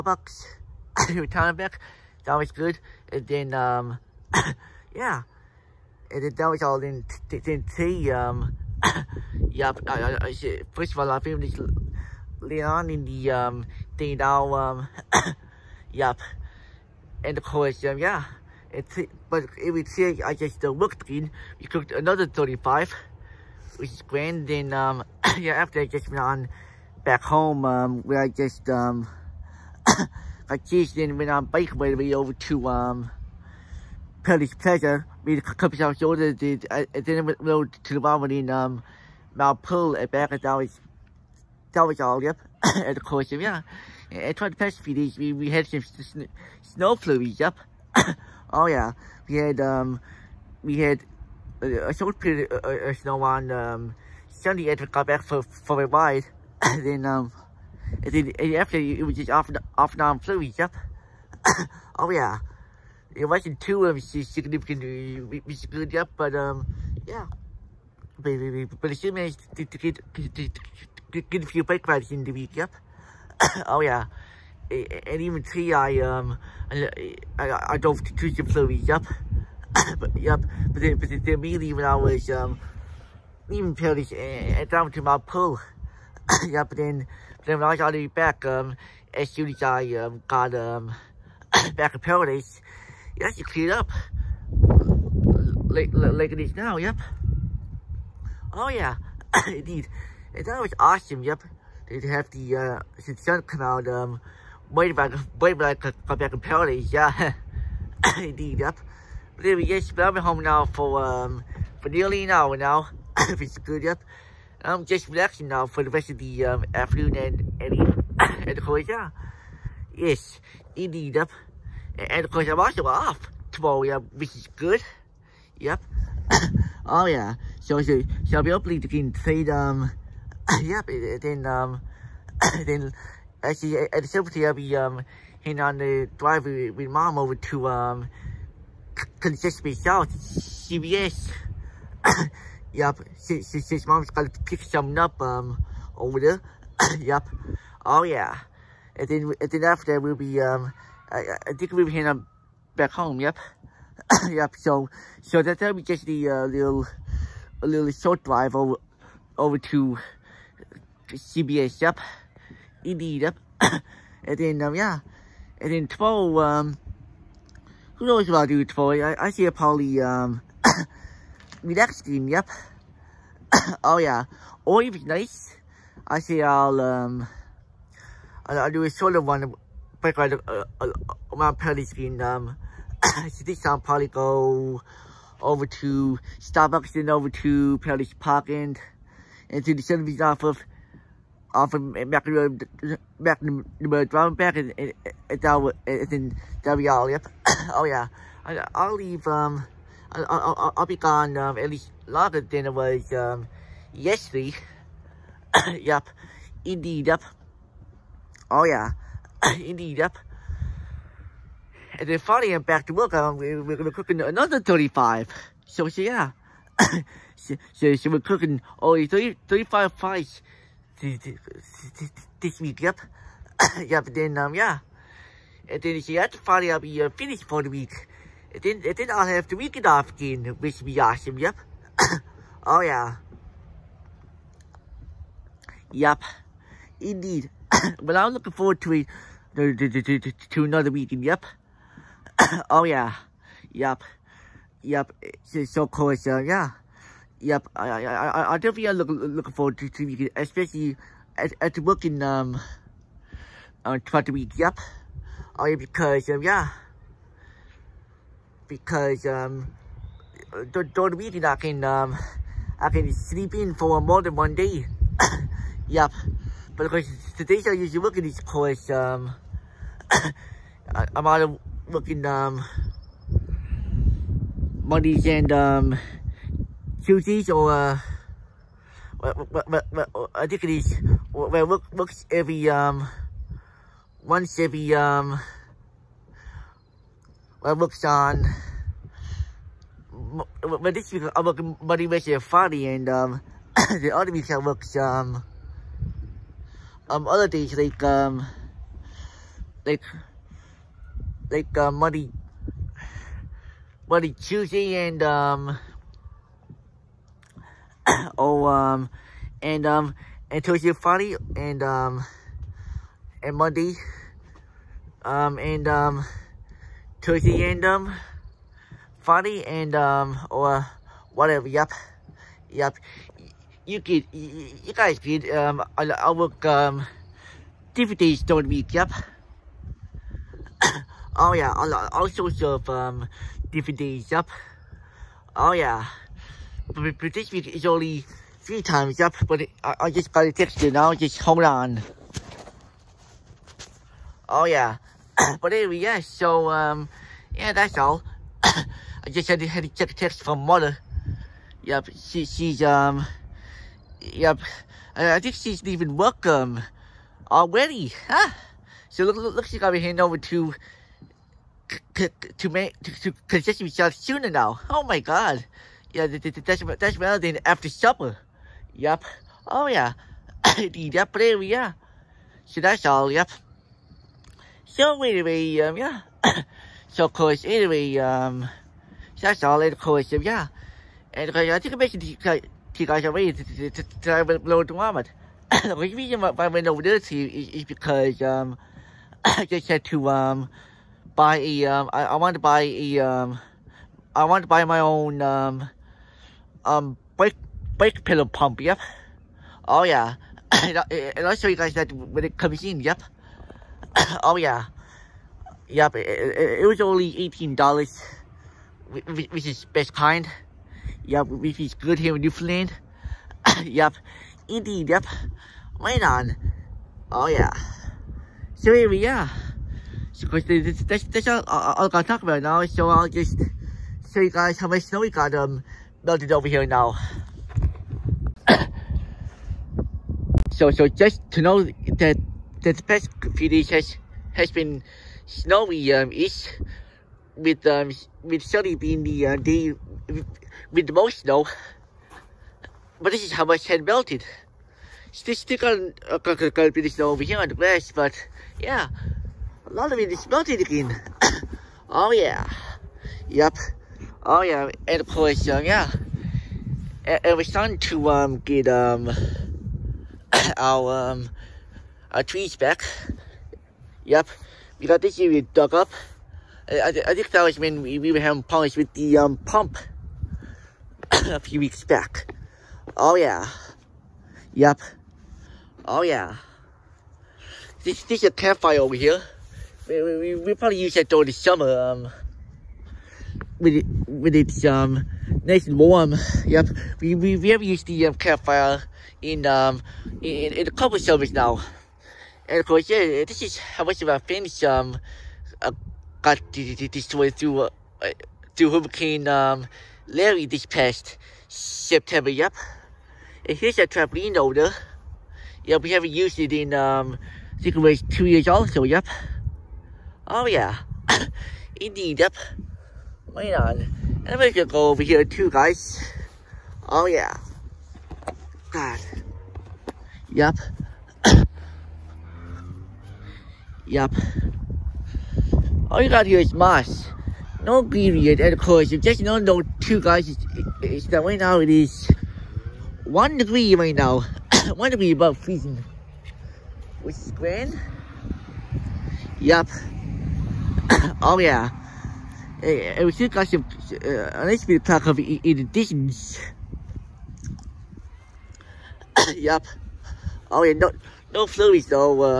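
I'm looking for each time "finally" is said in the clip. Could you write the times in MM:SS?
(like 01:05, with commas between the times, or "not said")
03:32, 03:46.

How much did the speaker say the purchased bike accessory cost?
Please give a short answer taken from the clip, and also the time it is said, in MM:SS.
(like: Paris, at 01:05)
$18, at 06:47.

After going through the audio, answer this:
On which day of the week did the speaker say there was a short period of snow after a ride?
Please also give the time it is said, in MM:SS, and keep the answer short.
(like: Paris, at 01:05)
Sunday, at 00:54.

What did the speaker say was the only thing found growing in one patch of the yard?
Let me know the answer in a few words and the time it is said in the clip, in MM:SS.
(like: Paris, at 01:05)
moss, at 08:46.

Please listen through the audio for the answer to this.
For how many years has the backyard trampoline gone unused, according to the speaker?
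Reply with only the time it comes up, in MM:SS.
08:28.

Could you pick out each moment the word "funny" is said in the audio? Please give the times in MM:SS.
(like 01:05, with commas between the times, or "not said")
04:52, 05:19.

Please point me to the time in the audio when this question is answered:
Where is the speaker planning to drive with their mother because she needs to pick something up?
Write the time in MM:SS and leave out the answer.
02:19.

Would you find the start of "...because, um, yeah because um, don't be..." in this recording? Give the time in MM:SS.
04:15.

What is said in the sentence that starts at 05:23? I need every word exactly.
You get you, guys get um, I, I work, um, DVDs don't week, yep.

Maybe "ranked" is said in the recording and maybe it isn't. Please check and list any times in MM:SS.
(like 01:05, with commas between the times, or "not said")
not said.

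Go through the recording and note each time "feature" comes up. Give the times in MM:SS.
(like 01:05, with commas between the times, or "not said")
not said.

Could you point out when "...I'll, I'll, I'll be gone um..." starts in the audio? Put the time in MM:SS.
03:20.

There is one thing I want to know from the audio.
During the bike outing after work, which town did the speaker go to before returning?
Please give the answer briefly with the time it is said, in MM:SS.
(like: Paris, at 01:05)
Mount Pearl, at 00:39.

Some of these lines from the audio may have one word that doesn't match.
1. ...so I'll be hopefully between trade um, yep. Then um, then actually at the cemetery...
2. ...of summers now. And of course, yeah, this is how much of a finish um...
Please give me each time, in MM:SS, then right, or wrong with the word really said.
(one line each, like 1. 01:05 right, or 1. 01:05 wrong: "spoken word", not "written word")
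1. 02:08 right
2. 08:11 right.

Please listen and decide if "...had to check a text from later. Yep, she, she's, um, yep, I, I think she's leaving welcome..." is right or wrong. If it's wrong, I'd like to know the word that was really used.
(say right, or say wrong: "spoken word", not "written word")
wrong: "mother", not "later".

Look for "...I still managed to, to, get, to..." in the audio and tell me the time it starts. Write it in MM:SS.
01:08.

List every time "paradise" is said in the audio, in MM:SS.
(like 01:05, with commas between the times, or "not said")
01:32, 01:46, 03:07.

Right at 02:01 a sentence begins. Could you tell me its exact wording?
And, the of course, I'm also off tomorrow, yeah, which is good.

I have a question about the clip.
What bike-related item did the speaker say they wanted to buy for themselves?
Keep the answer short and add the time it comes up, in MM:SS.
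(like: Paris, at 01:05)
brake pedal pump, at 06:37.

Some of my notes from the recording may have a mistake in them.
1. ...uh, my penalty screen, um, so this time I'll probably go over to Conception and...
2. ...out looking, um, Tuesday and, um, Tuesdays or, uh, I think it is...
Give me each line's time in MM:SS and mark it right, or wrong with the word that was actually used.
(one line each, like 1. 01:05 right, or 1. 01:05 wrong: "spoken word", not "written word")
1. 03:00 wrong: "Starbucks", not "Conception"
2. 04:31 wrong: "Mondays", not "Tuesday".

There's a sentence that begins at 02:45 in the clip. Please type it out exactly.
And then tomorrow, um, who knows what I'll do tomorrow?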